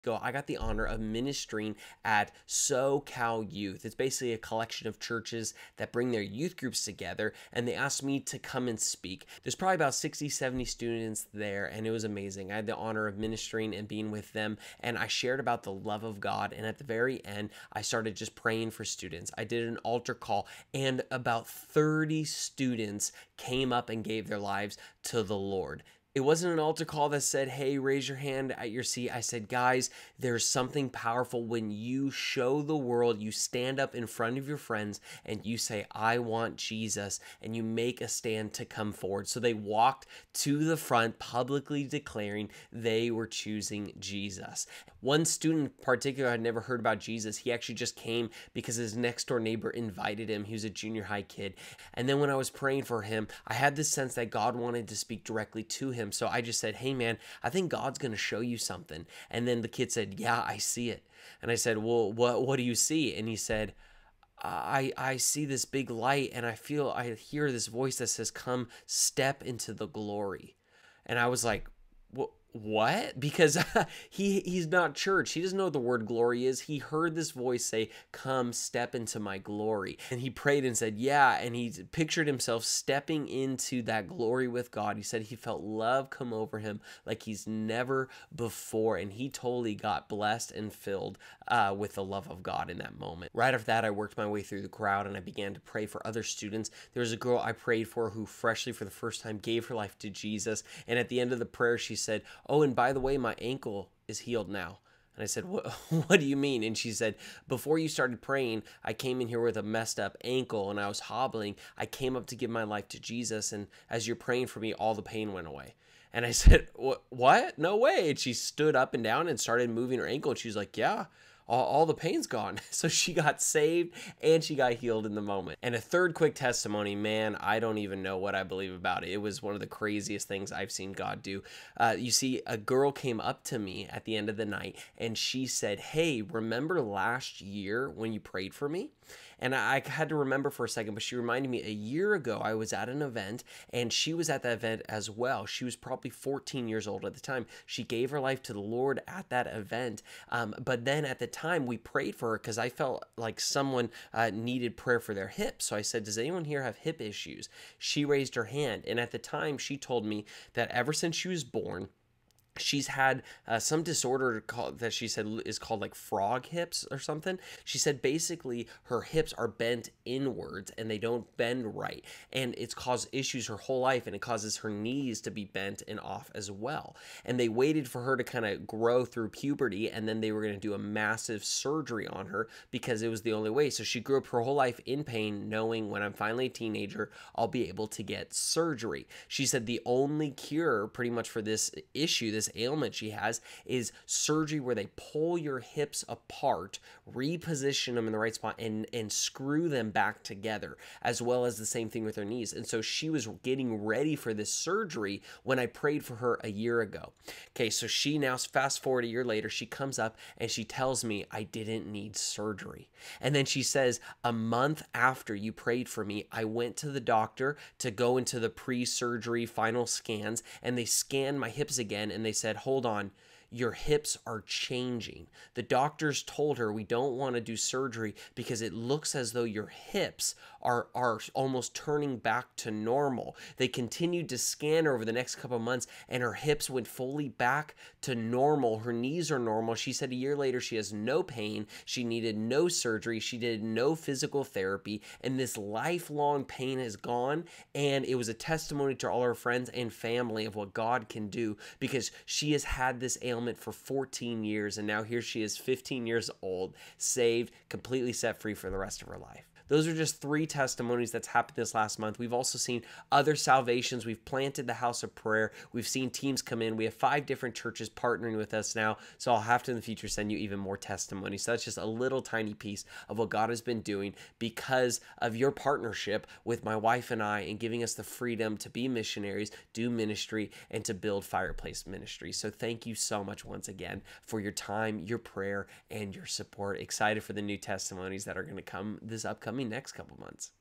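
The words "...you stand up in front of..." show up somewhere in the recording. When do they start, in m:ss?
0:33.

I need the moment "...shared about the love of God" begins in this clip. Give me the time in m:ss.
0:15.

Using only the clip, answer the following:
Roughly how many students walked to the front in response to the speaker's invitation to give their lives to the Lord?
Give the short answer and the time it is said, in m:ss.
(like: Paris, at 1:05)
30, at 0:21.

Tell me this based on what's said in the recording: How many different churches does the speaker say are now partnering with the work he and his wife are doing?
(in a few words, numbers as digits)
5.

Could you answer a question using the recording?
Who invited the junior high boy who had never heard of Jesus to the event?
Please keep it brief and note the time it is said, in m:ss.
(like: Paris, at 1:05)
His next door neighbor, at 0:48.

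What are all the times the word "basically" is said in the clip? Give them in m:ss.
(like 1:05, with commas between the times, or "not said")
0:03, 2:48.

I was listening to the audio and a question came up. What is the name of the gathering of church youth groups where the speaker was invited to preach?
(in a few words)
SoCal Youth.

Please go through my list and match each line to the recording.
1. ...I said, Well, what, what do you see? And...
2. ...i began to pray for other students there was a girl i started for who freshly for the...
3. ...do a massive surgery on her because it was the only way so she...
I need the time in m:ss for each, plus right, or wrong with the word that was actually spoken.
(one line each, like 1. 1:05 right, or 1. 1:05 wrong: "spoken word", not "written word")
1. 1:01 right
2. 1:35 wrong: "prayed", not "started"
3. 3:00 right.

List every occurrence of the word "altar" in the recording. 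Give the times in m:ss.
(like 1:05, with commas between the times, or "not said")
0:19, 0:26.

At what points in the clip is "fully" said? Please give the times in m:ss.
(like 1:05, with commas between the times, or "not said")
3:56.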